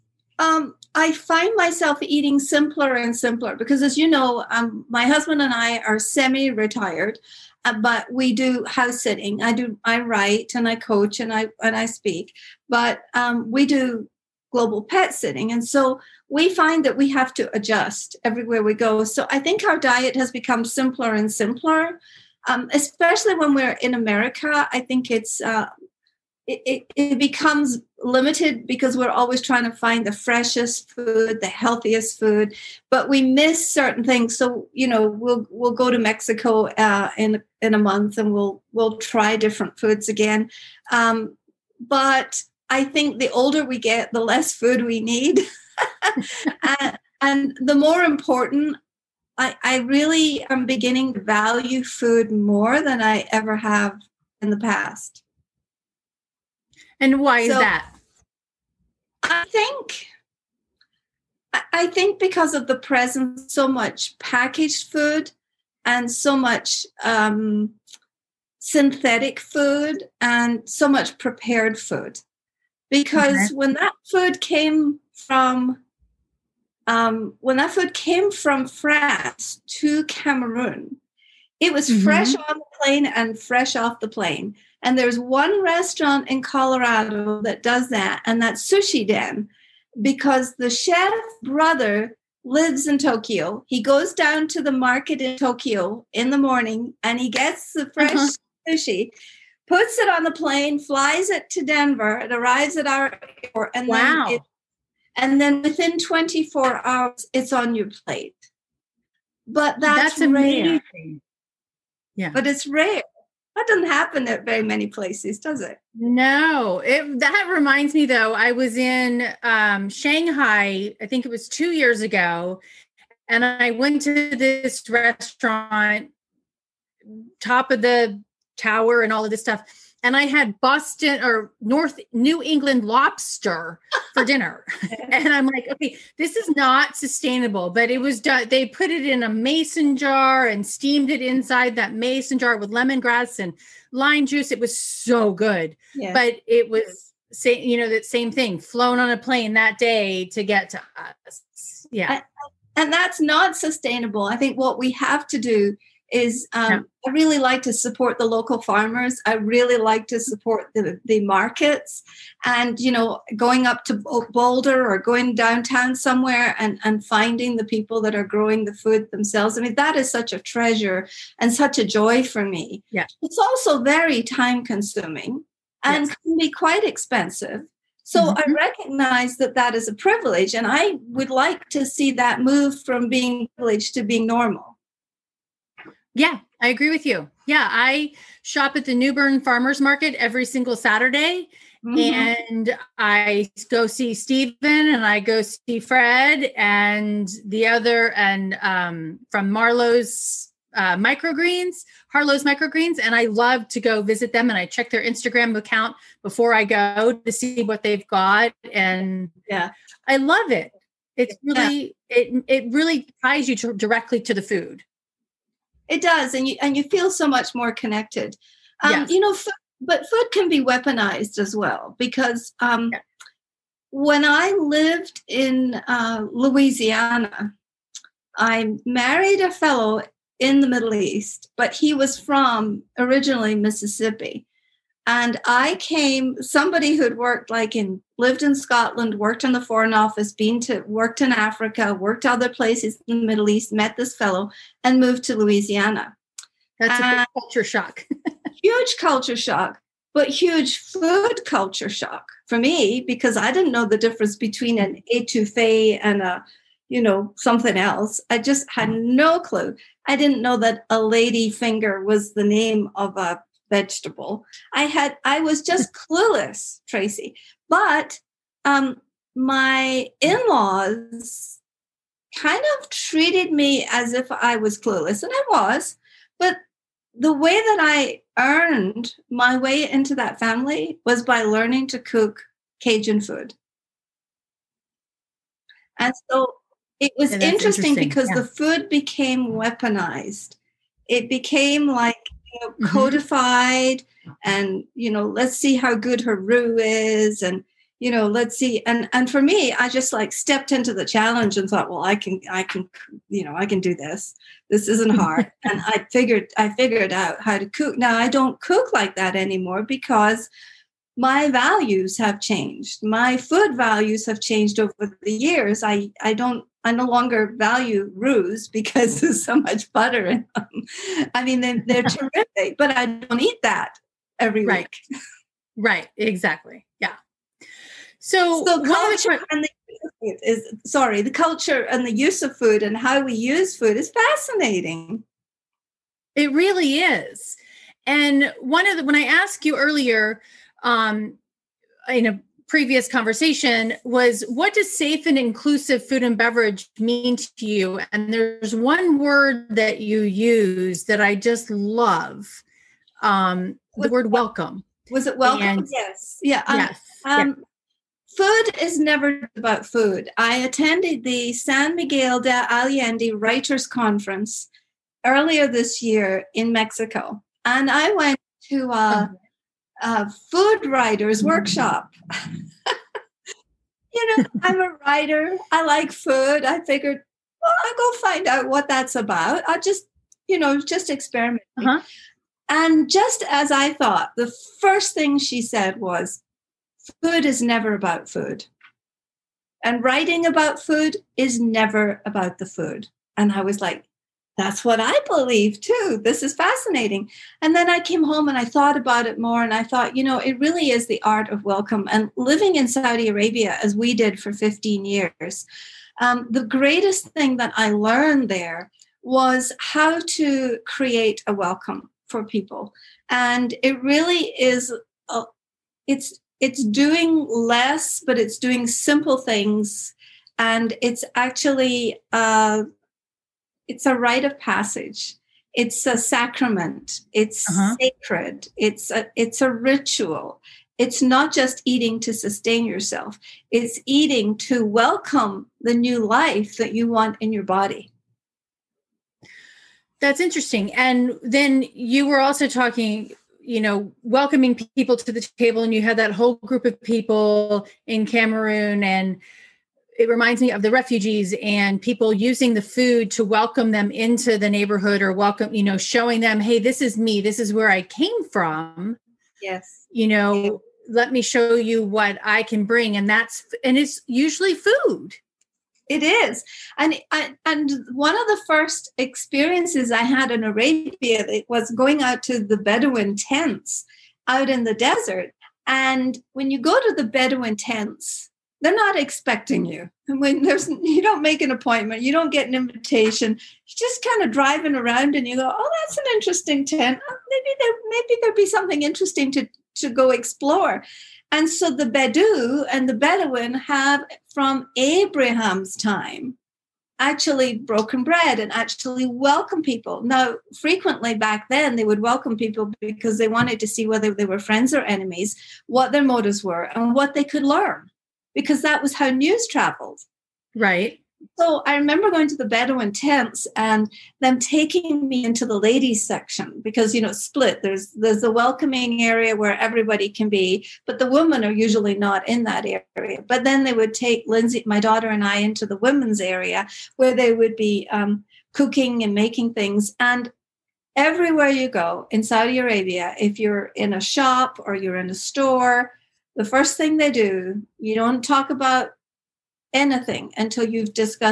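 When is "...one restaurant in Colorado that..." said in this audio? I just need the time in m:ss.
1:25.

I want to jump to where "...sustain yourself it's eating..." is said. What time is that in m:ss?
7:12.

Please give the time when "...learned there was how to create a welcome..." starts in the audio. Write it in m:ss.
6:47.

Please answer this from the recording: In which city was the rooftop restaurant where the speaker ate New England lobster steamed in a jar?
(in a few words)
Shanghai.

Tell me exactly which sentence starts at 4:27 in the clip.
But um, my in-laws kind of treated me as if I was clueless, and I was.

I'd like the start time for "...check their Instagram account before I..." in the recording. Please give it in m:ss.
3:24.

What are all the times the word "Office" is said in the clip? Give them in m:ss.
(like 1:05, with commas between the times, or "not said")
3:59.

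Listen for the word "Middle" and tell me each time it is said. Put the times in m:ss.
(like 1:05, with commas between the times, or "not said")
3:50, 4:03.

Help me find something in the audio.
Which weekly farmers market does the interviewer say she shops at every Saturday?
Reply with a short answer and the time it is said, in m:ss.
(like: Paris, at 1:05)
Newburn Farmers Market, at 3:08.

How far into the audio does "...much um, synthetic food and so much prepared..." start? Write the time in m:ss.
1:06.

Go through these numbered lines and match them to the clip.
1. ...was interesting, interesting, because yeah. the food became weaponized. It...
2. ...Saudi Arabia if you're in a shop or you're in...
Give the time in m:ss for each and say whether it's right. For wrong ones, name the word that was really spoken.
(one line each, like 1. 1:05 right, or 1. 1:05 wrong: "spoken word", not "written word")
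1. 4:47 right
2. 8:52 right.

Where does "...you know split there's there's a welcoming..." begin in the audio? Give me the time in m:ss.
8:37.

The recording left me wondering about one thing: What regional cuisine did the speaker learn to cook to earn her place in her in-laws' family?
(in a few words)
Cajun.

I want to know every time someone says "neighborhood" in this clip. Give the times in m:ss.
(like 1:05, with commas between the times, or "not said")
7:34.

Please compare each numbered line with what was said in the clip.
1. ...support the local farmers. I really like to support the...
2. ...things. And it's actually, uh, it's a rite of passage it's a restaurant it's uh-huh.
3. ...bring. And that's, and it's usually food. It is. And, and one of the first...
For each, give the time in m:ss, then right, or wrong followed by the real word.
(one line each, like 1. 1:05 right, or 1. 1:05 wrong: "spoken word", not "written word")
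1. 2:37 right
2. 6:59 wrong: "sacrament", not "restaurant"
3. 7:42 right.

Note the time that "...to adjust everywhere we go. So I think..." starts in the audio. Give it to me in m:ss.
0:17.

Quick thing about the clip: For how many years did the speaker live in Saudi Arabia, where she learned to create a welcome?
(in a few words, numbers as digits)
15.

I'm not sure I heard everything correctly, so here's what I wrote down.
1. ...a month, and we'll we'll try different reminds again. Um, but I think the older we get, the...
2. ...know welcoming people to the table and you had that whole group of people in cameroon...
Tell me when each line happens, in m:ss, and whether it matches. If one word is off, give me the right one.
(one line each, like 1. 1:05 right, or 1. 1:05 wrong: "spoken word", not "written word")
1. 0:37 wrong: "foods", not "reminds"
2. 7:23 right.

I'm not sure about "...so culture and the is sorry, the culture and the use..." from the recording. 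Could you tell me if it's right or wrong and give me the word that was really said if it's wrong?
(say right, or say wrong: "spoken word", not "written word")
right.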